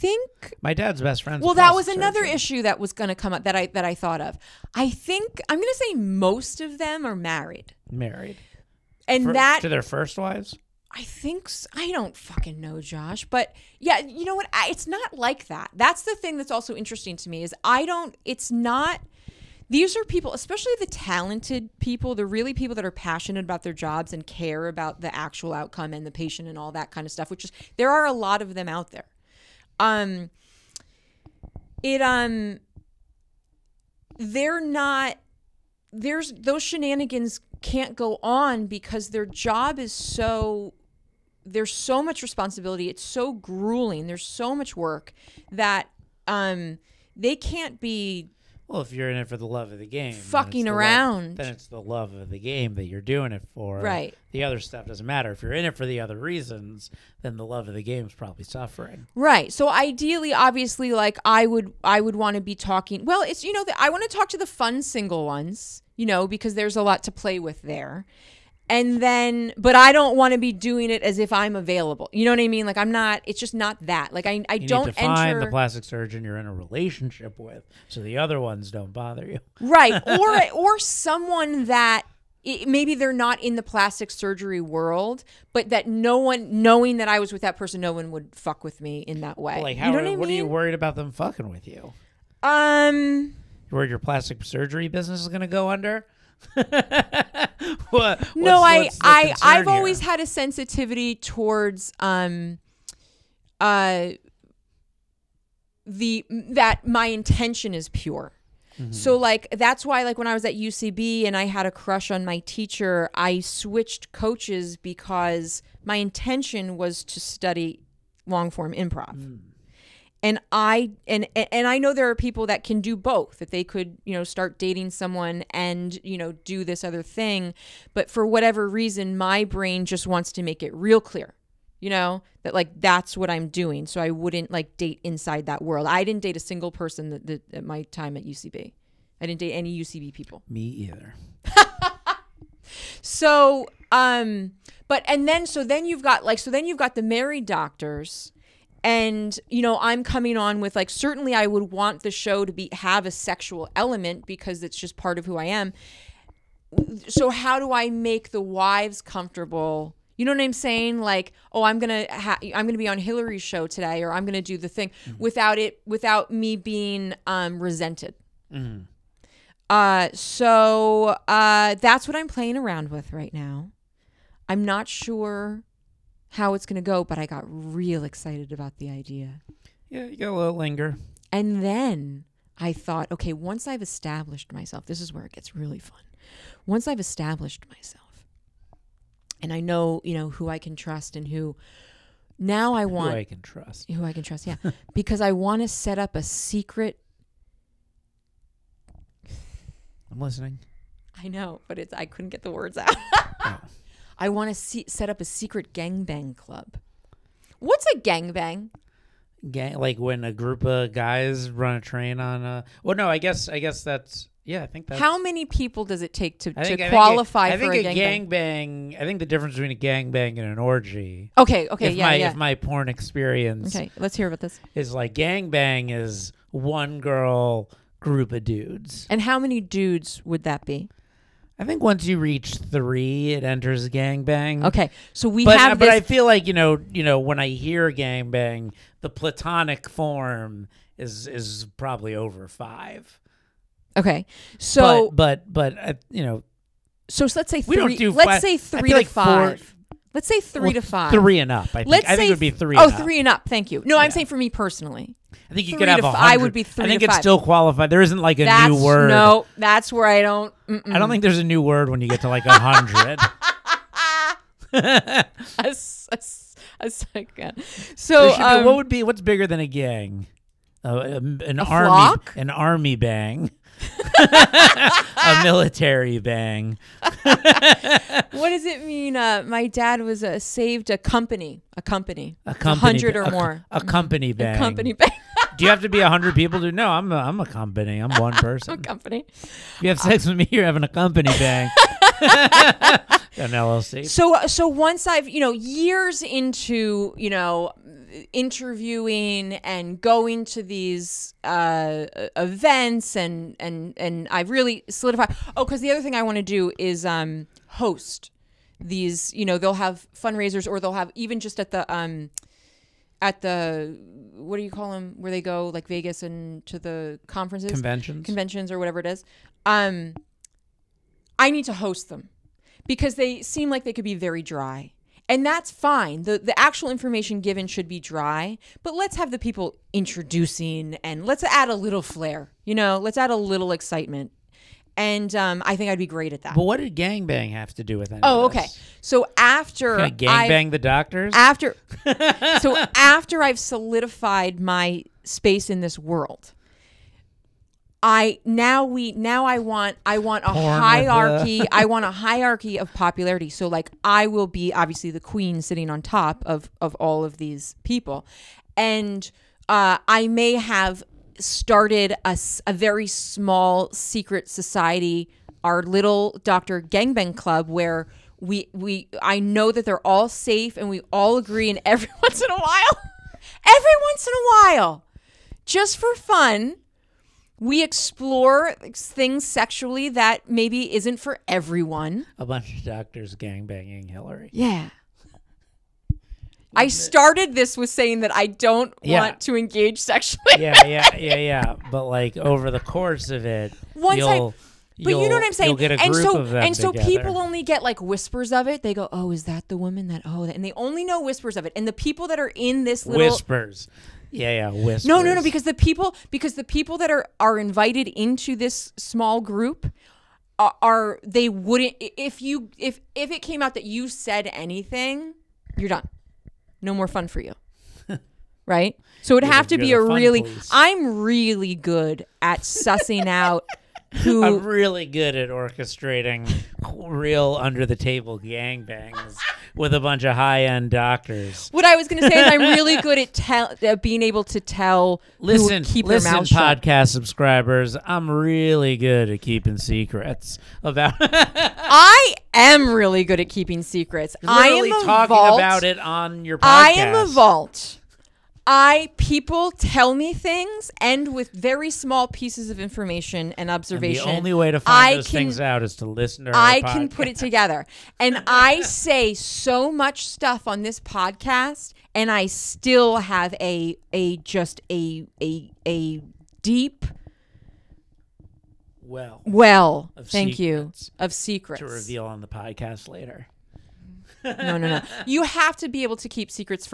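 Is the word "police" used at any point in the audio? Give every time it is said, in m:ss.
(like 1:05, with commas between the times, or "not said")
7:00.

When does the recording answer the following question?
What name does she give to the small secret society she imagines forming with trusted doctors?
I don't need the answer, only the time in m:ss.
6:06.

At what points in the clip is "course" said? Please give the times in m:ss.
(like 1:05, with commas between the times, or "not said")
6:32.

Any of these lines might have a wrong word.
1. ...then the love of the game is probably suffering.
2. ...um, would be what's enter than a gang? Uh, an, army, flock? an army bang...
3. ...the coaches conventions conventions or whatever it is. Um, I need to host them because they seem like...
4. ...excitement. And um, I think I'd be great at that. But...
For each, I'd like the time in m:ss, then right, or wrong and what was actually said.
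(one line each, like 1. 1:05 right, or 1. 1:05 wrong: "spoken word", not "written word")
1. 0:57 right
2. 4:28 wrong: "bigger", not "enter"
3. 5:16 wrong: "conferences", not "coaches"
4. 5:33 right.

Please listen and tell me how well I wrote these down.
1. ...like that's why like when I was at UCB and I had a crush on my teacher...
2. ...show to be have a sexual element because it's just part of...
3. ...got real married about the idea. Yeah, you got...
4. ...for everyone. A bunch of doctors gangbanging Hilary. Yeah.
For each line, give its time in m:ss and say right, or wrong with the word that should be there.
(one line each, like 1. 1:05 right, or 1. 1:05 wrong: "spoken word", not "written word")
1. 1:49 right
2. 2:32 right
3. 2:57 wrong: "excited", not "married"
4. 6:21 right.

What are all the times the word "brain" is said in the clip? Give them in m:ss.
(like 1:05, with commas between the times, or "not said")
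2:09.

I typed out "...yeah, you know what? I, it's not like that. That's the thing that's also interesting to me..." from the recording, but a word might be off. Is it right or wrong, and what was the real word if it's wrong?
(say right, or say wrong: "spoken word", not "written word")
right.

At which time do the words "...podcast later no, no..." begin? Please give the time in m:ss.
7:52.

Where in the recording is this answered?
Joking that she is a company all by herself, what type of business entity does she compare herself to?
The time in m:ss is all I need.
4:53.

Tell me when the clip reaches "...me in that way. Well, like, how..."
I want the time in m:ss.
1:28.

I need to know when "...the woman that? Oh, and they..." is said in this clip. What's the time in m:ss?
6:39.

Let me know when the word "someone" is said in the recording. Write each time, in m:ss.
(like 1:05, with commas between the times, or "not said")
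1:20, 2:04.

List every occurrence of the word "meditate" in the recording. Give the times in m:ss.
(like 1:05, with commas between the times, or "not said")
not said.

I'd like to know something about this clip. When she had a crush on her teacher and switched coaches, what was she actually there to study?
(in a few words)
long form improv.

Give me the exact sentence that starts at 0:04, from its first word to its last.
I think I'm going to say most of them are married.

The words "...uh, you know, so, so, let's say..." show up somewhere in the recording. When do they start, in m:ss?
4:05.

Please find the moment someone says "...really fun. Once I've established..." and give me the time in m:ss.
3:05.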